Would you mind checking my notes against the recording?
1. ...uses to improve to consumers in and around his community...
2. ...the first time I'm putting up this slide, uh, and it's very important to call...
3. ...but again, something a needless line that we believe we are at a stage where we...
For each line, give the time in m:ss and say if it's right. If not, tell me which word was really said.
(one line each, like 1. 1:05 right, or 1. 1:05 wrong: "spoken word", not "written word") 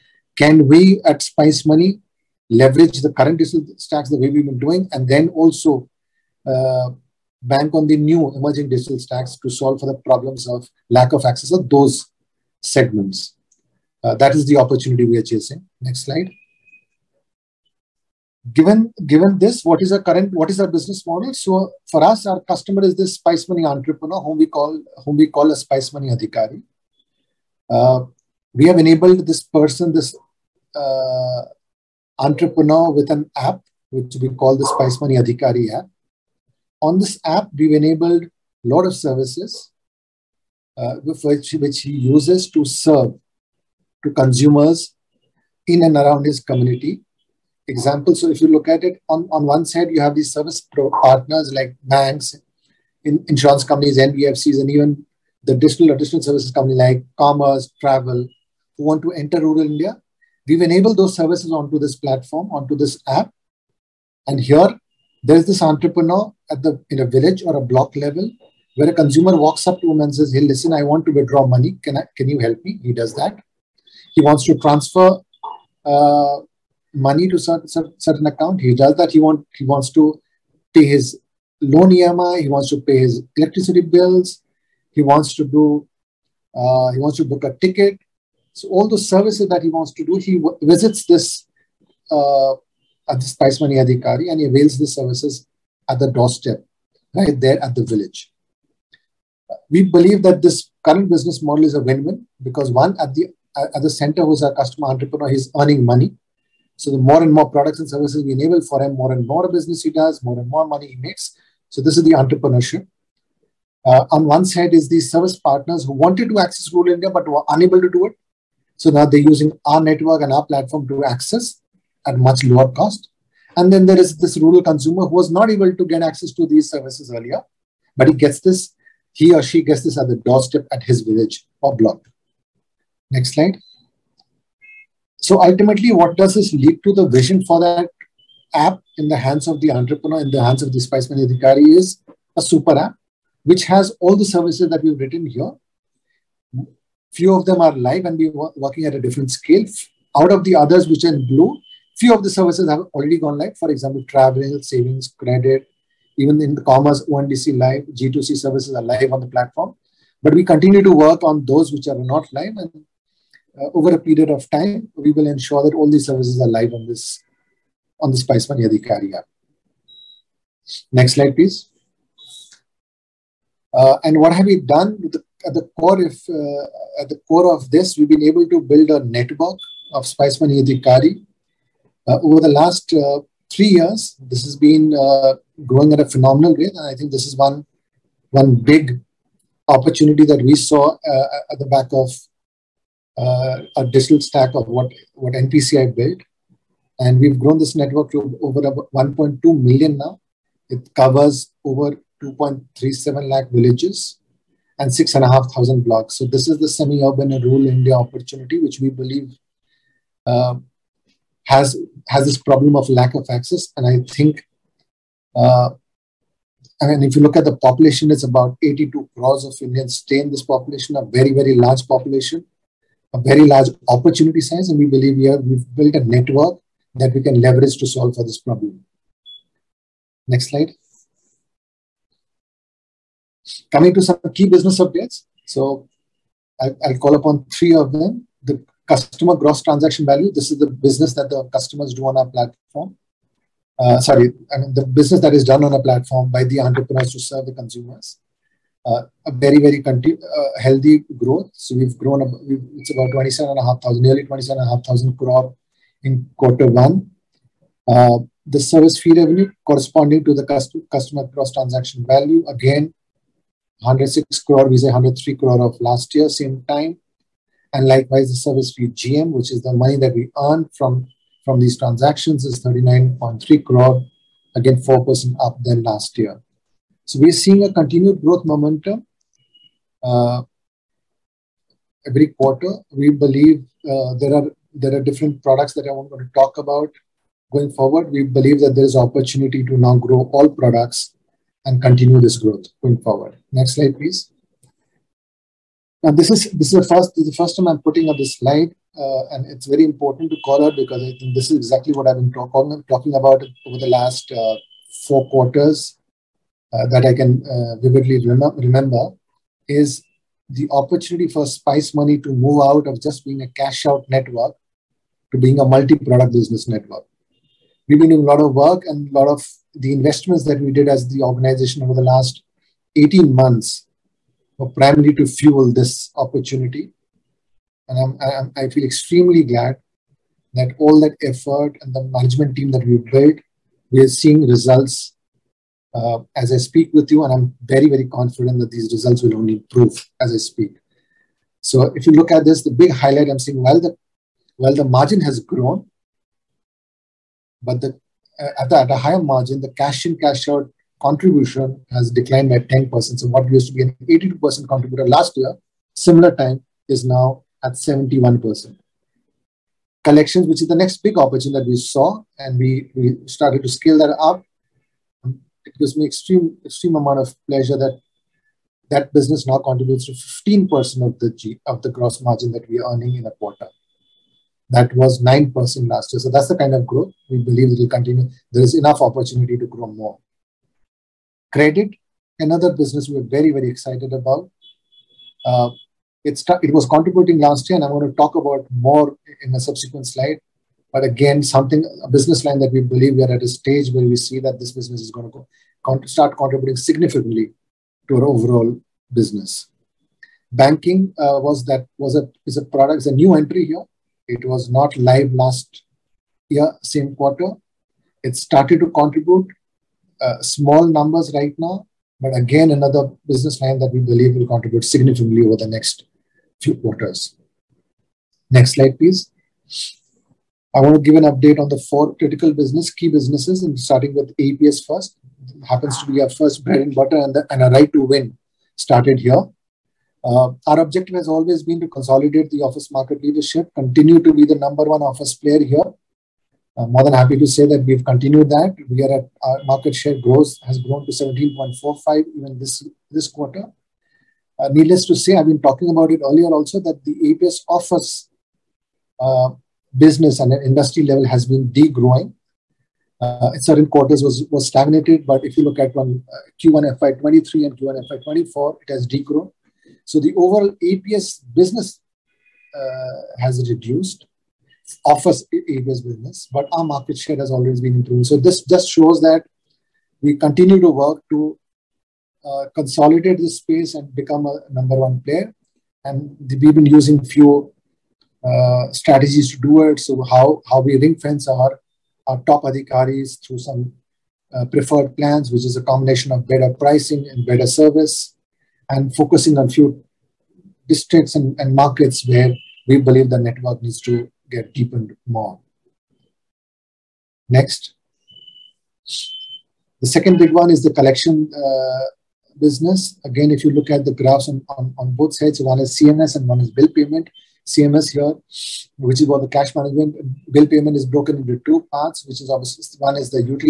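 1. 0:41 wrong: "serve", not "improve"
2. 4:57 right
3. 6:30 wrong: "business", not "needless".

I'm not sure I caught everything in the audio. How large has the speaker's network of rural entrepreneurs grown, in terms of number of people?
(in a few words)
1.2 million.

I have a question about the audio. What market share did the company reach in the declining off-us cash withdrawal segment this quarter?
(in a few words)
17.45.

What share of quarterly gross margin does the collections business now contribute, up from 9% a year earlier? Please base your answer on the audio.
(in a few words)
15%.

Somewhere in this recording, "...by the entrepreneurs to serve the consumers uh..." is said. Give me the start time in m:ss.
4:06.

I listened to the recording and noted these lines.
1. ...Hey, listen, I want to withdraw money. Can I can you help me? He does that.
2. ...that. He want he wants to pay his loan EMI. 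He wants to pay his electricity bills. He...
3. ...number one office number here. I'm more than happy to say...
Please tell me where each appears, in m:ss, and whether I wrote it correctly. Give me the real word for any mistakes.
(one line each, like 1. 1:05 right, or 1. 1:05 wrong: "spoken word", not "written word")
1. 1:10 right
2. 1:18 right
3. 7:14 wrong: "player", not "number".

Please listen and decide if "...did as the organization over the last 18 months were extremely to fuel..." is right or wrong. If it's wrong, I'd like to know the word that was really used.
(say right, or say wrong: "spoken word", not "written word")
wrong: "primarily", not "extremely".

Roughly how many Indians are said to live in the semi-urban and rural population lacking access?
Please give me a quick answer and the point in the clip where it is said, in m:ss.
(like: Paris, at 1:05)
82 crore, at 3:38.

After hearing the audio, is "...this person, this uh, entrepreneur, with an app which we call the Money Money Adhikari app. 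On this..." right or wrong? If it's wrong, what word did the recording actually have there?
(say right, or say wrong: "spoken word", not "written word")
wrong: "Spice", not "Money".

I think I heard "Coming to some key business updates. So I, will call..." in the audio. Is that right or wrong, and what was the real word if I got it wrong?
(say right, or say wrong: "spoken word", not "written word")
right.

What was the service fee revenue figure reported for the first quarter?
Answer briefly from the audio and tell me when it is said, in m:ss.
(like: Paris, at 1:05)
106 crore, at 4:23.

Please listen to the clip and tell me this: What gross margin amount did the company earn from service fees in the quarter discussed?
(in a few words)
39.3 crore.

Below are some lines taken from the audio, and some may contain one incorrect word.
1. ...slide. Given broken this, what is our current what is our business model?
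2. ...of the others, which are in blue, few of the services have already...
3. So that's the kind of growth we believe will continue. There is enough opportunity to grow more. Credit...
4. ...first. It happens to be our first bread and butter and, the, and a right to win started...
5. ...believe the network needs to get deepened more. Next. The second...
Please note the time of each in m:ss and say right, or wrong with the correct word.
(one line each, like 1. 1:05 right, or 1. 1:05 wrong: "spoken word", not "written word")
1. 0:16 wrong: "given", not "broken"
2. 2:30 right
3. 6:16 right
4. 7:04 right
5. 8:12 right.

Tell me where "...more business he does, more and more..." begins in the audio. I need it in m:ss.
1:49.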